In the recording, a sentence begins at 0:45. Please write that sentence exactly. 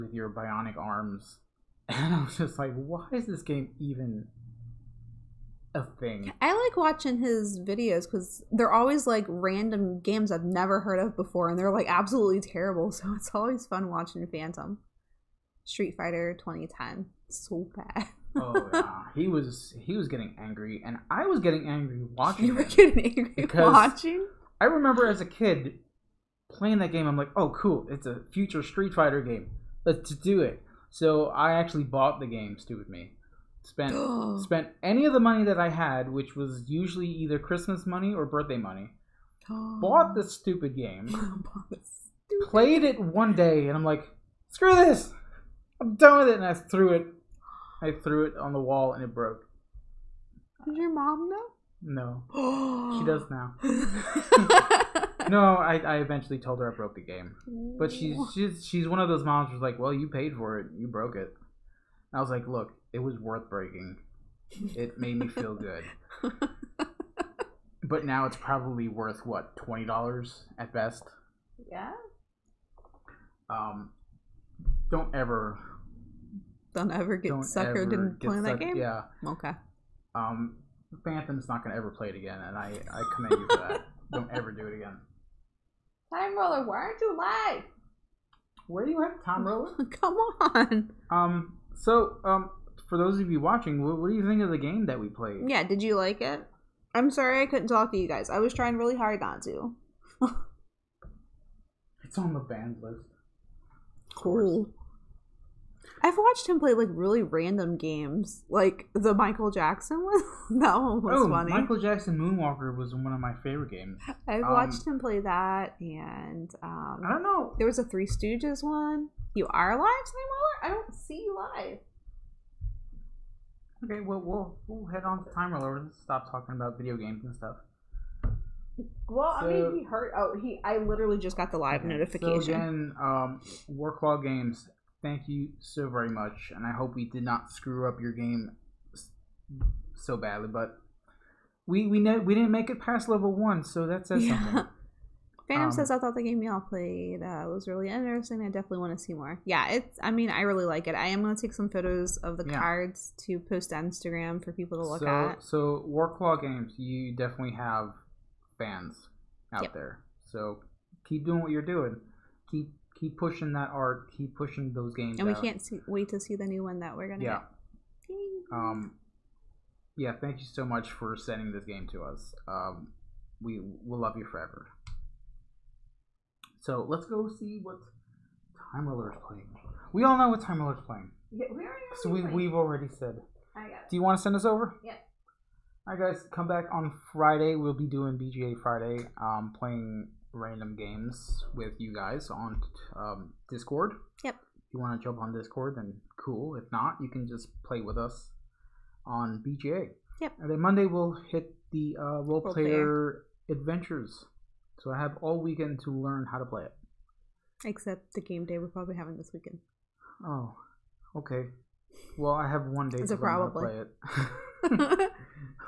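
I'm done with it, and I threw it I threw it on the wall and it broke.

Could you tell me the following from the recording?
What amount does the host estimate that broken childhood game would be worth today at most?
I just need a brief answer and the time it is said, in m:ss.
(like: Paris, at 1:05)
$20, at 1:09.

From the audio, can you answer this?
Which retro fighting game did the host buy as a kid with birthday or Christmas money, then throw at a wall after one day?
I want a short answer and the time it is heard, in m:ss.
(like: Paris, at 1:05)
Street Fighter 2010, at 0:15.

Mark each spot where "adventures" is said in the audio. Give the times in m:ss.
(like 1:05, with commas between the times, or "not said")
3:23.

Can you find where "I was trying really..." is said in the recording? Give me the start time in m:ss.
1:38.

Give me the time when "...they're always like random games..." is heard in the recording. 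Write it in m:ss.
0:08.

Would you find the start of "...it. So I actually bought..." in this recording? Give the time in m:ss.
0:30.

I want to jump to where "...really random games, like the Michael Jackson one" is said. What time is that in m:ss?
1:46.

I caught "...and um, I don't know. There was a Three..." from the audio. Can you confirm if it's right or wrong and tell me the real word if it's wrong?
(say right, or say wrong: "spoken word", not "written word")
right.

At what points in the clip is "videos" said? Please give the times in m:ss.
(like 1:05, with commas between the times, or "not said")
0:07, 2:06.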